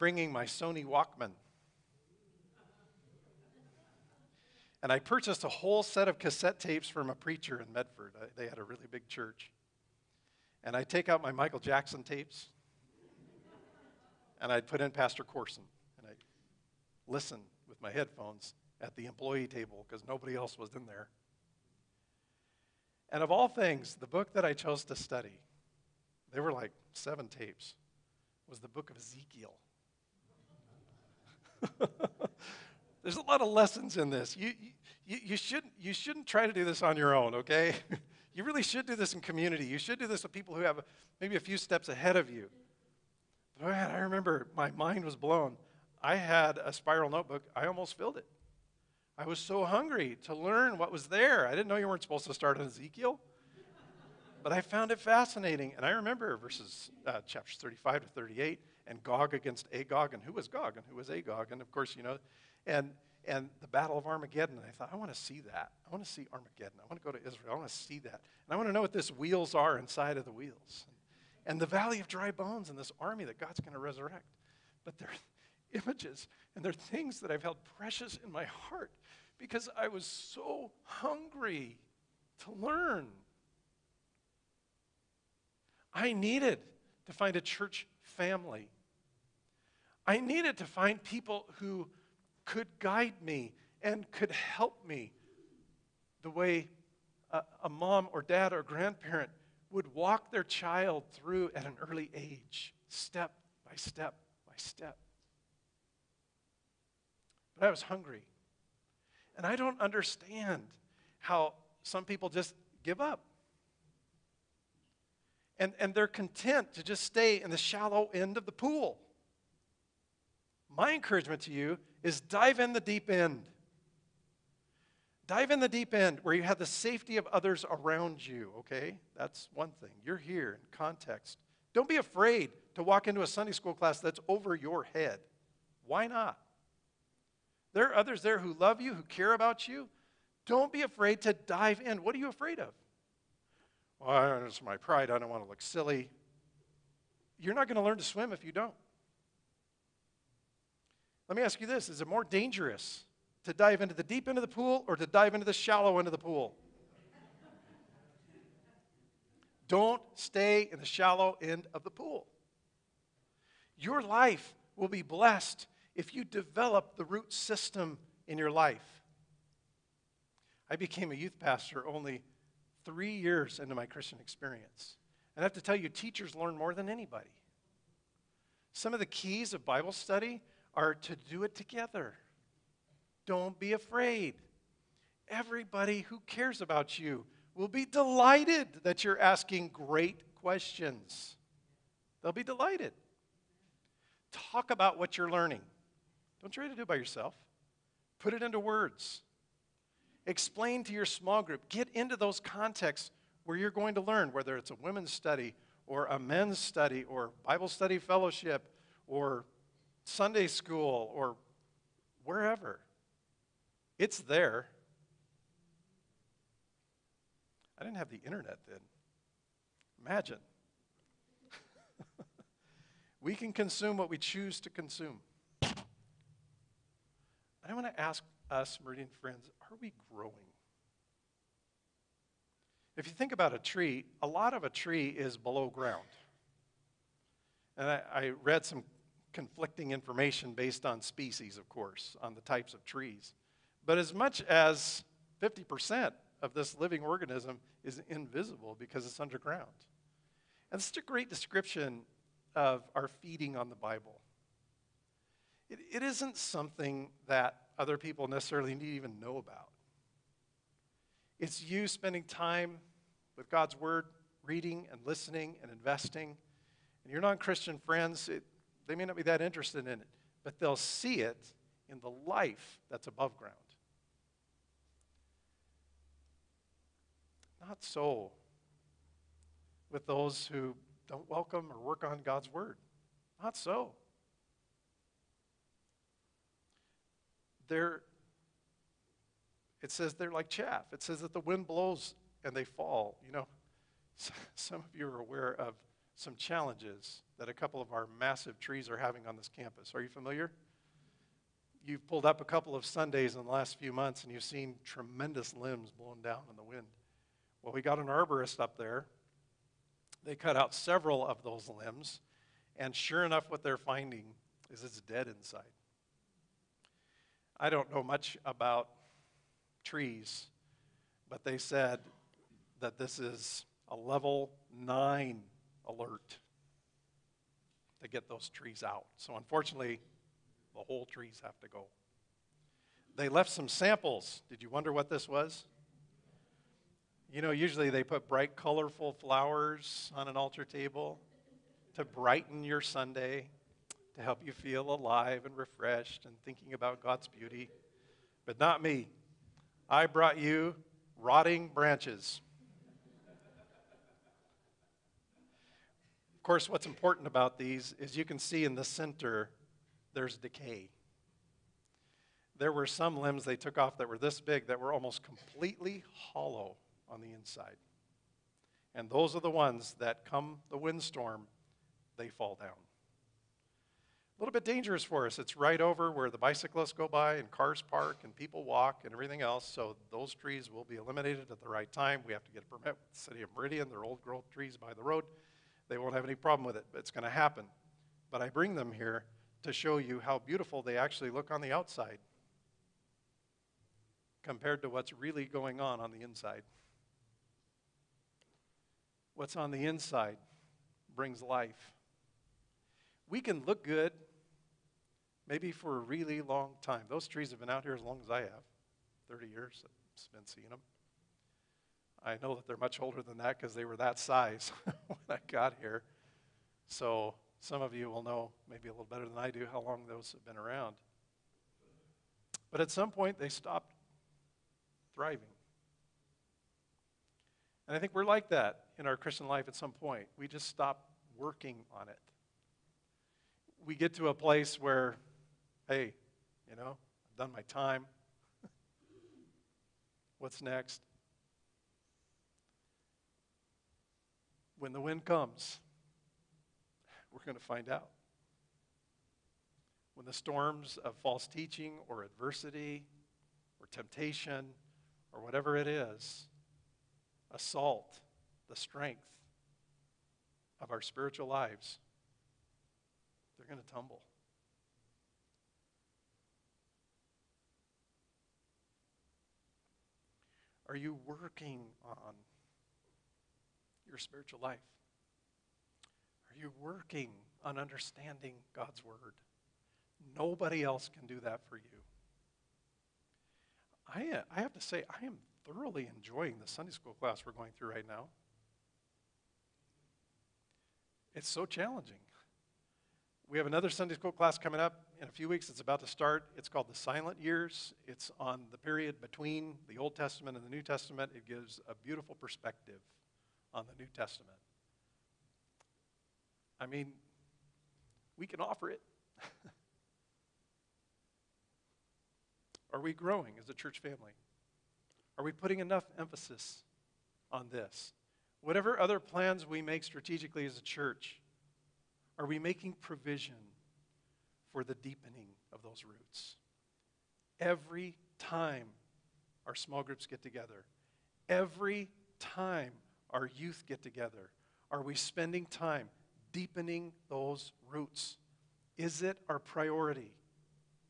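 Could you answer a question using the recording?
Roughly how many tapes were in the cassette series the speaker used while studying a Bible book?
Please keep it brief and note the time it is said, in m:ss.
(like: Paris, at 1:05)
7, at 0:26.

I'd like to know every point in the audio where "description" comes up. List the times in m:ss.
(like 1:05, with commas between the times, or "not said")
4:11.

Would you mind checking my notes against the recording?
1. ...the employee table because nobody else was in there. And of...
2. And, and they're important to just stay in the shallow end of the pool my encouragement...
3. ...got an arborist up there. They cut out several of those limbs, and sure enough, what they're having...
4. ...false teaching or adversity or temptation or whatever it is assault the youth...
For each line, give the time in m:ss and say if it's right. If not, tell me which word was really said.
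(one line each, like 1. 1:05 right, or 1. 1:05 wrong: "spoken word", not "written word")
1. 0:18 right
2. 1:55 wrong: "content", not "important"
3. 5:07 wrong: "finding", not "having"
4. 7:31 wrong: "strength", not "youth".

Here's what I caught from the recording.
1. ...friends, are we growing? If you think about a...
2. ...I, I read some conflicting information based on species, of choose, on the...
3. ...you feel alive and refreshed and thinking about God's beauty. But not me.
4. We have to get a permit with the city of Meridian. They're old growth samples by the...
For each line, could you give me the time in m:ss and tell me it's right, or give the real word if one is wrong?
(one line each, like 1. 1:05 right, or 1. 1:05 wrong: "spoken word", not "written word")
1. 3:49 right
2. 3:57 wrong: "course", not "choose"
3. 5:44 right
4. 6:22 wrong: "trees", not "samples".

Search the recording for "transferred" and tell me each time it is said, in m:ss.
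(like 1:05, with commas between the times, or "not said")
not said.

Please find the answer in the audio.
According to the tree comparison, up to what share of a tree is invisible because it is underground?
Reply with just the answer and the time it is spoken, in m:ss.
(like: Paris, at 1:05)
50%, at 4:05.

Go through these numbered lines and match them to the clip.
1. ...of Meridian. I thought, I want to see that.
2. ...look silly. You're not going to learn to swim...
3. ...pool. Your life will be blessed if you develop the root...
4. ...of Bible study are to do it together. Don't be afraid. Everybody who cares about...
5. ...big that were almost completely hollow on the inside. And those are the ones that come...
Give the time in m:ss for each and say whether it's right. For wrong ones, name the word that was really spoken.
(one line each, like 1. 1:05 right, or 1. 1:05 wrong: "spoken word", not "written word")
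1. 1:03 wrong: "Armageddon", not "Meridian"
2. 2:25 right
3. 2:41 right
4. 2:59 right
5. 6:04 right.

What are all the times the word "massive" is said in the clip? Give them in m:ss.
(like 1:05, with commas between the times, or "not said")
4:58.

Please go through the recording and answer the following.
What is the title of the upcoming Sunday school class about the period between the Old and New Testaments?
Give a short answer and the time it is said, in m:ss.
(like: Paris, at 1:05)
The Silent Years, at 8:16.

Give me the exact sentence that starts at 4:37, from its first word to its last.
Not so with those who don't welcome or work on God's word.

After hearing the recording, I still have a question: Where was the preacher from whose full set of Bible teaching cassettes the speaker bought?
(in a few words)
Medford.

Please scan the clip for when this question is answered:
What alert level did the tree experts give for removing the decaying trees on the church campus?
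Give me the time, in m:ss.
5:23.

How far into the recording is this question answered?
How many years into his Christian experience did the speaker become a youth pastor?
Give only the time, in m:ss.
2:52.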